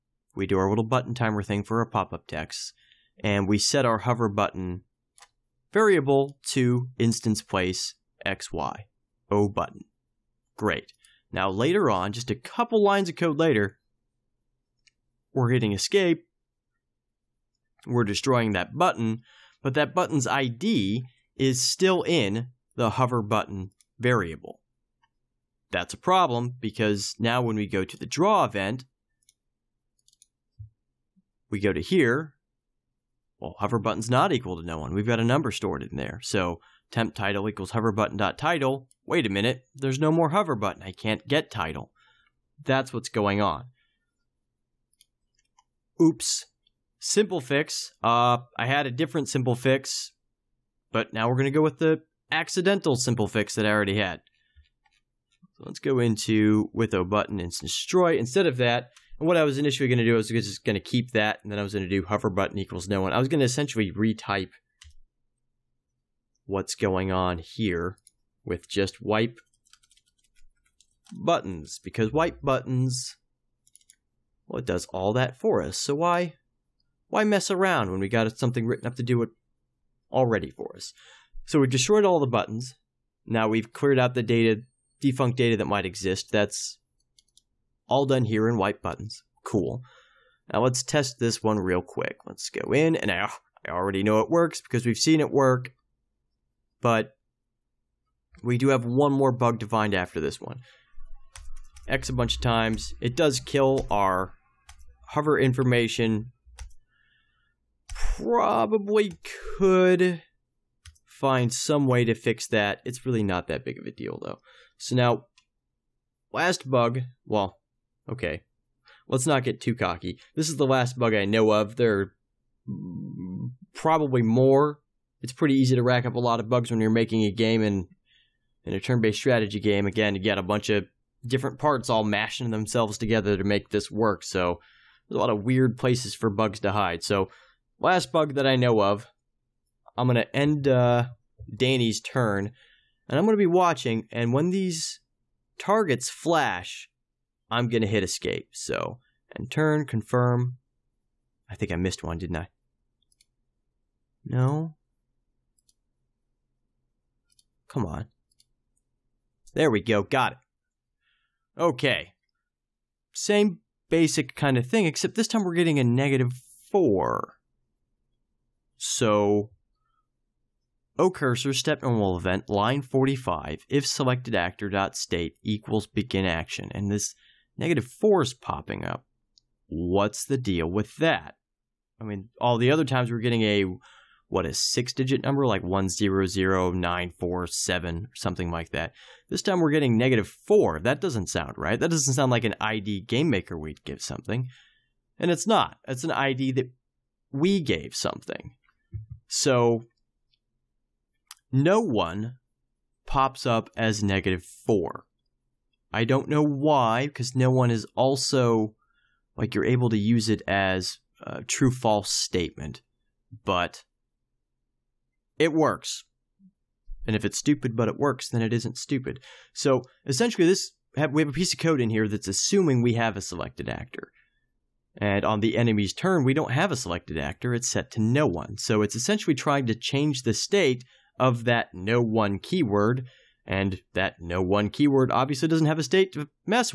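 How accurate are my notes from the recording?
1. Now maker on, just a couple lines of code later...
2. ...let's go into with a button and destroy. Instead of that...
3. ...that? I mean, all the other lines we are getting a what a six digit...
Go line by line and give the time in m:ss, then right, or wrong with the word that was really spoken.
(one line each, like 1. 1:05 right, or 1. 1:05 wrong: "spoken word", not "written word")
1. 0:11 wrong: "later", not "maker"
2. 0:55 right
3. 3:00 wrong: "times", not "lines".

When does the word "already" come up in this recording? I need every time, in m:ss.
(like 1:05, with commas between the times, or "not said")
0:53, 1:20, 1:33.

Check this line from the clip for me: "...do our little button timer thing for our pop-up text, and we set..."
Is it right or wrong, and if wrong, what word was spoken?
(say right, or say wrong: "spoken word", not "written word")
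right.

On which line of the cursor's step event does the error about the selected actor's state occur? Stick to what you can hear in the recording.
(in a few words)
45.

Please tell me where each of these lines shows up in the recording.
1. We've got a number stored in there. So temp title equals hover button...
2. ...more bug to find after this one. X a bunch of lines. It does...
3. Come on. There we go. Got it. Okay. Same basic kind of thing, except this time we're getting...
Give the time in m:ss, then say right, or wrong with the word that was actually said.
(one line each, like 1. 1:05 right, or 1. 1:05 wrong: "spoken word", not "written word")
1. 0:34 right
2. 1:39 wrong: "times", not "lines"
3. 2:37 right.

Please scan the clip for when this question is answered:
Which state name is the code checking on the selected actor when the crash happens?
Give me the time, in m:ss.
2:55.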